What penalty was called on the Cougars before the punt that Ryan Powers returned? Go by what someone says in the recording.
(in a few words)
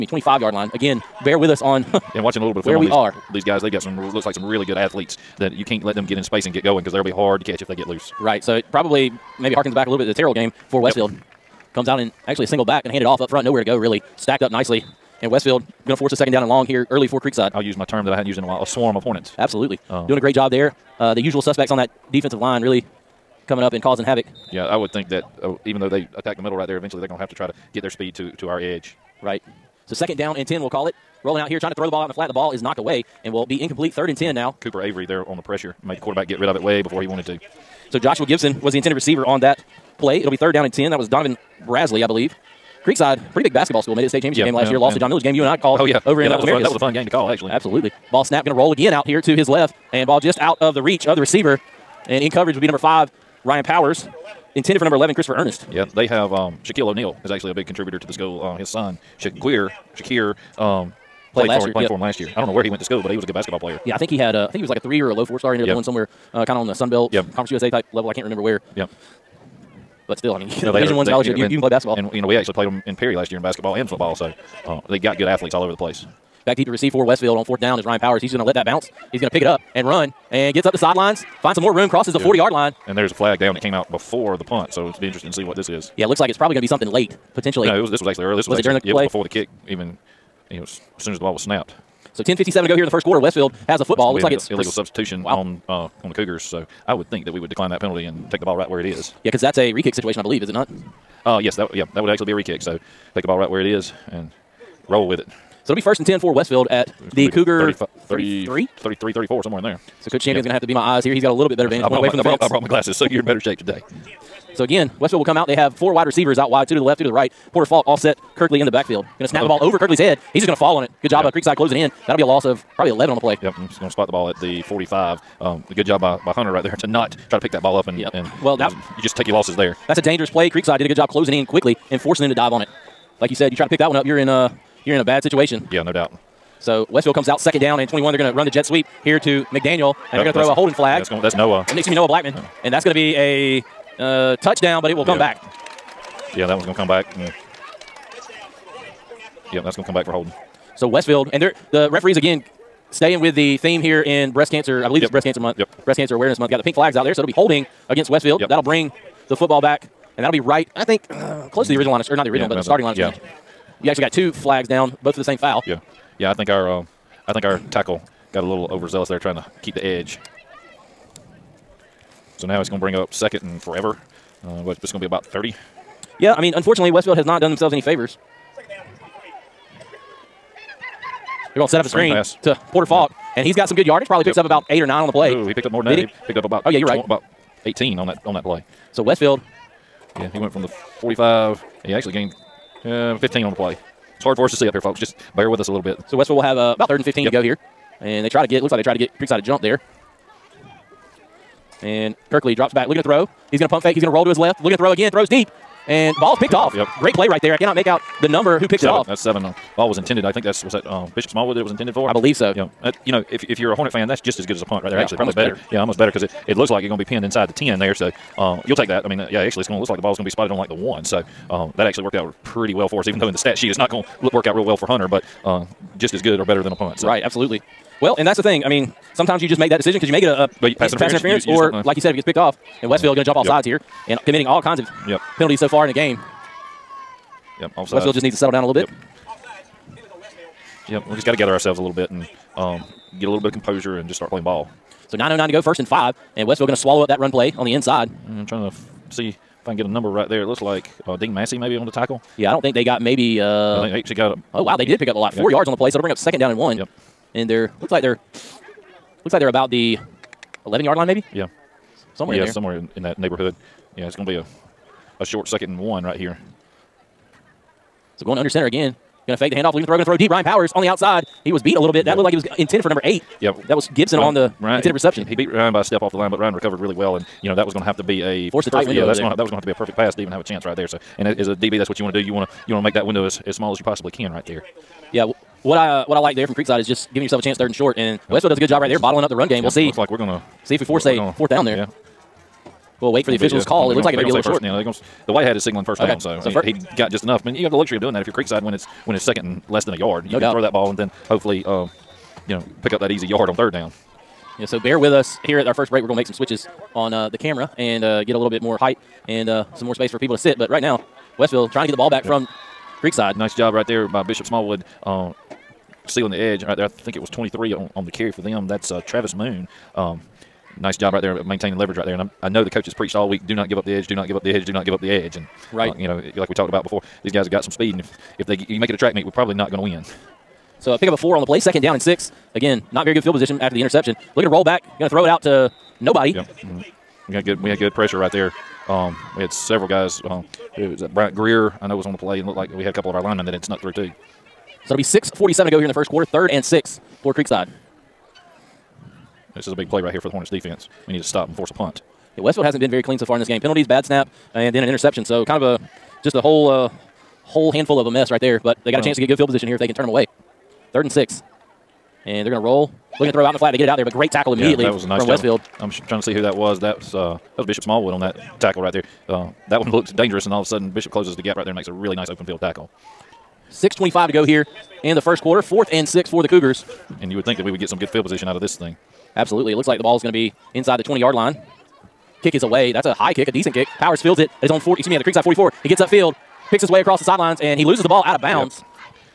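Illegal substitution.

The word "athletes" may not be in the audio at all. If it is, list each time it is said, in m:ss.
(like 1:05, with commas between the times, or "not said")
0:04, 1:15.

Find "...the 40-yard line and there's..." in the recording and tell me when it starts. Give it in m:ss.
1:22.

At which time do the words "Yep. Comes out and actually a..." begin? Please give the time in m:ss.
0:11.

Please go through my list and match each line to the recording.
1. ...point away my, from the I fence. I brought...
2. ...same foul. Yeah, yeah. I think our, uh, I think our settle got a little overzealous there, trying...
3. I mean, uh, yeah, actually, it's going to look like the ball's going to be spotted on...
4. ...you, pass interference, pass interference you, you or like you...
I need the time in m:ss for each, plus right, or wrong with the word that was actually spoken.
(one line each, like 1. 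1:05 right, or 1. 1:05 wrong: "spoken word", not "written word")
1. 1:51 right
2. 2:45 wrong: "tackle", not "settle"
3. 3:39 right
4. 3:50 right.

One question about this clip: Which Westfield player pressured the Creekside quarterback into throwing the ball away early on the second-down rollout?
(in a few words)
Cooper Avery.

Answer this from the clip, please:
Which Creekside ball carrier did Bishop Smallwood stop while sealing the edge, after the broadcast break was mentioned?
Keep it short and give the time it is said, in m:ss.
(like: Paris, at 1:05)
Travis Moon, at 5:19.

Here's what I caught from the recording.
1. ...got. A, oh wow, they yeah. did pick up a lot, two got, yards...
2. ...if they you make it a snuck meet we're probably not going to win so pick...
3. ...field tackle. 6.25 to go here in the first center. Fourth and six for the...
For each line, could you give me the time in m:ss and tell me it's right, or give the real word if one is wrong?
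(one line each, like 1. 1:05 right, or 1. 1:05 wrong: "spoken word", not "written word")
1. 4:14 wrong: "four", not "two"
2. 5:28 wrong: "track", not "snuck"
3. 6:12 wrong: "quarter", not "center".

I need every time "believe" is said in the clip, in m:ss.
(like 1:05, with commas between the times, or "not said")
0:42, 1:40, 2:34, 3:32.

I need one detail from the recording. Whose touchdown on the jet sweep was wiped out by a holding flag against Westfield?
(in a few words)
Noah Blackman.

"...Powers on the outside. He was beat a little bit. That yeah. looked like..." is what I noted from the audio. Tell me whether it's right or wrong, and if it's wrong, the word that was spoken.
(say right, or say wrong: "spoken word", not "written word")
right.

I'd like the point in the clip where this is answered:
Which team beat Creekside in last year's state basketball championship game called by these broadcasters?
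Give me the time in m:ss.
0:44.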